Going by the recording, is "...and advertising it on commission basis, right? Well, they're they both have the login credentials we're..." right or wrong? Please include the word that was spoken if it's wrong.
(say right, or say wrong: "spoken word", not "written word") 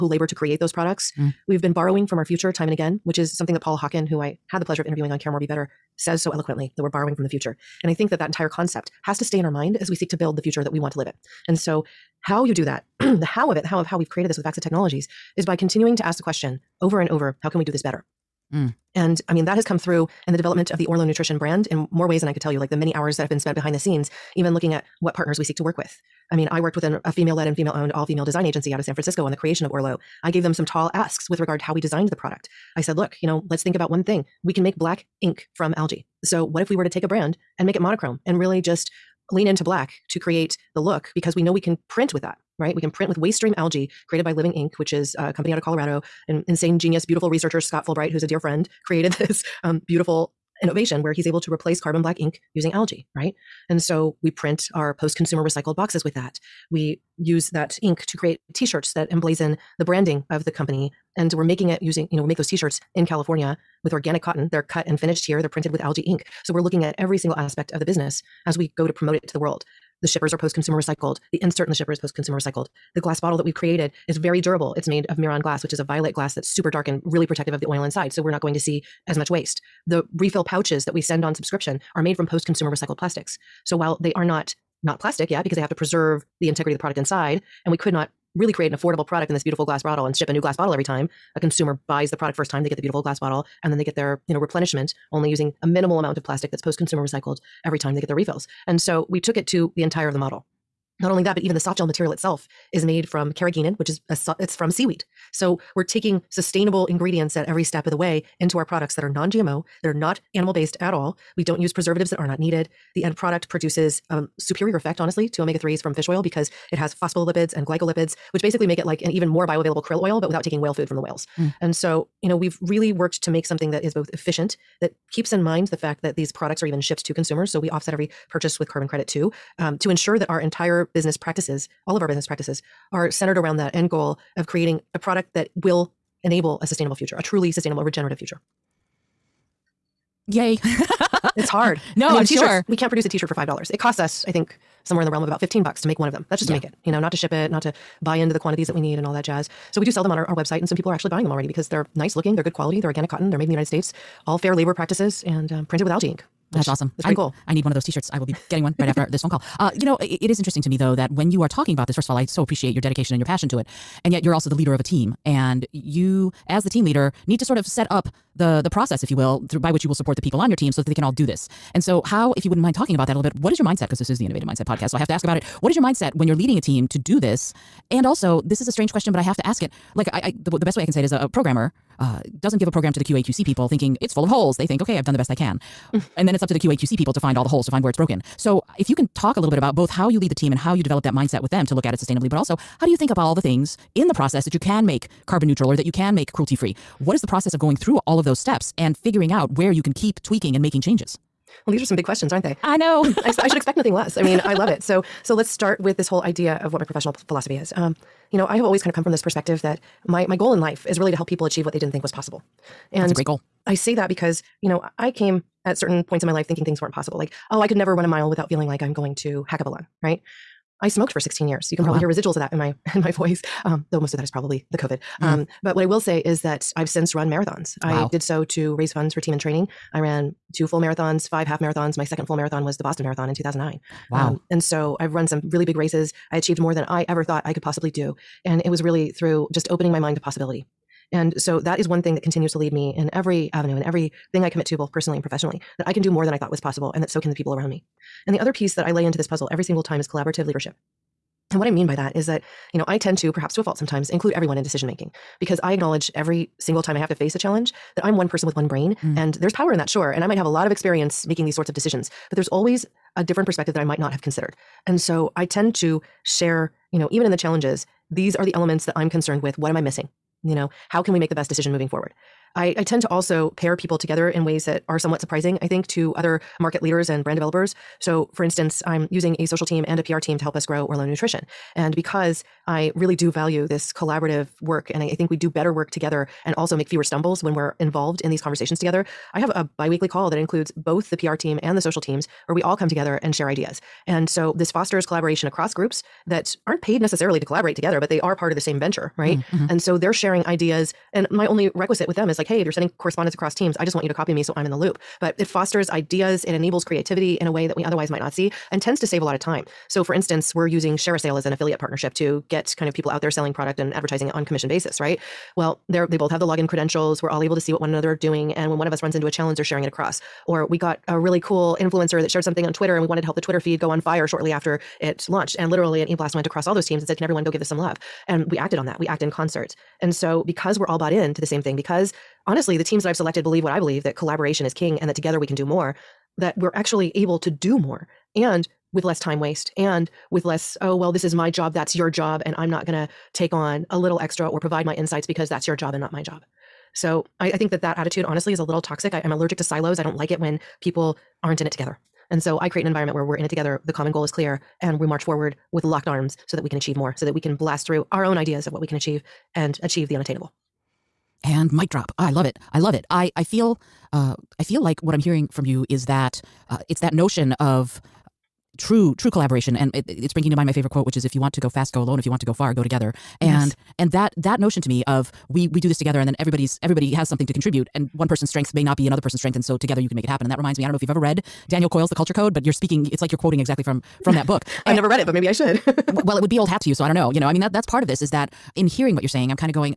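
right.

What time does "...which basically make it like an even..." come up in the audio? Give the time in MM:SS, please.
01:58.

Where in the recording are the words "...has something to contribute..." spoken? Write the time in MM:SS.
06:17.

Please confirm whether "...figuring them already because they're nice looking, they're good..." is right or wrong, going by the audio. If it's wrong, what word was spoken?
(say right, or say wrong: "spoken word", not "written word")
wrong: "buying", not "figuring".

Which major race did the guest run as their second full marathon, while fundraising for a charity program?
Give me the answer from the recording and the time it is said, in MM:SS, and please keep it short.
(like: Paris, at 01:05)
Boston Marathon, at 03:52.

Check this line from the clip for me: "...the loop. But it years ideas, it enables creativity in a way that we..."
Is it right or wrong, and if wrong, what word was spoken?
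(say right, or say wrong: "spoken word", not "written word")
wrong: "fosters", not "years".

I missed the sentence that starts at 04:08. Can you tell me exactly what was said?
And the other piece that I lay into this puzzle every single time is collaborative leadership.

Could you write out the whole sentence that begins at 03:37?
Like, oh, I could never run a mile without feeling like I'm going to hack a balloon, right?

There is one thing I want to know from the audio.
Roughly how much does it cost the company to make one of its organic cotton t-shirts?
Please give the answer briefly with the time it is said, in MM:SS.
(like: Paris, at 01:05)
15 bucks, at 02:25.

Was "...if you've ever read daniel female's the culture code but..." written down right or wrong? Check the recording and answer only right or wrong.
wrong.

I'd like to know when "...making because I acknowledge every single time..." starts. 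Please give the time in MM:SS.
04:14.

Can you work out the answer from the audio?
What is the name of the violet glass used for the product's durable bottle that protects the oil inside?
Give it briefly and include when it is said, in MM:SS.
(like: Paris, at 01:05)
Miron glass, at 01:15.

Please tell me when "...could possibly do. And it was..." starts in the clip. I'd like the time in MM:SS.
03:57.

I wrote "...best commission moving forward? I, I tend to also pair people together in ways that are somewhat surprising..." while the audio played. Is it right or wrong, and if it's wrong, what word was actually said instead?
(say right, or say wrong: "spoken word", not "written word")
wrong: "decision", not "commission".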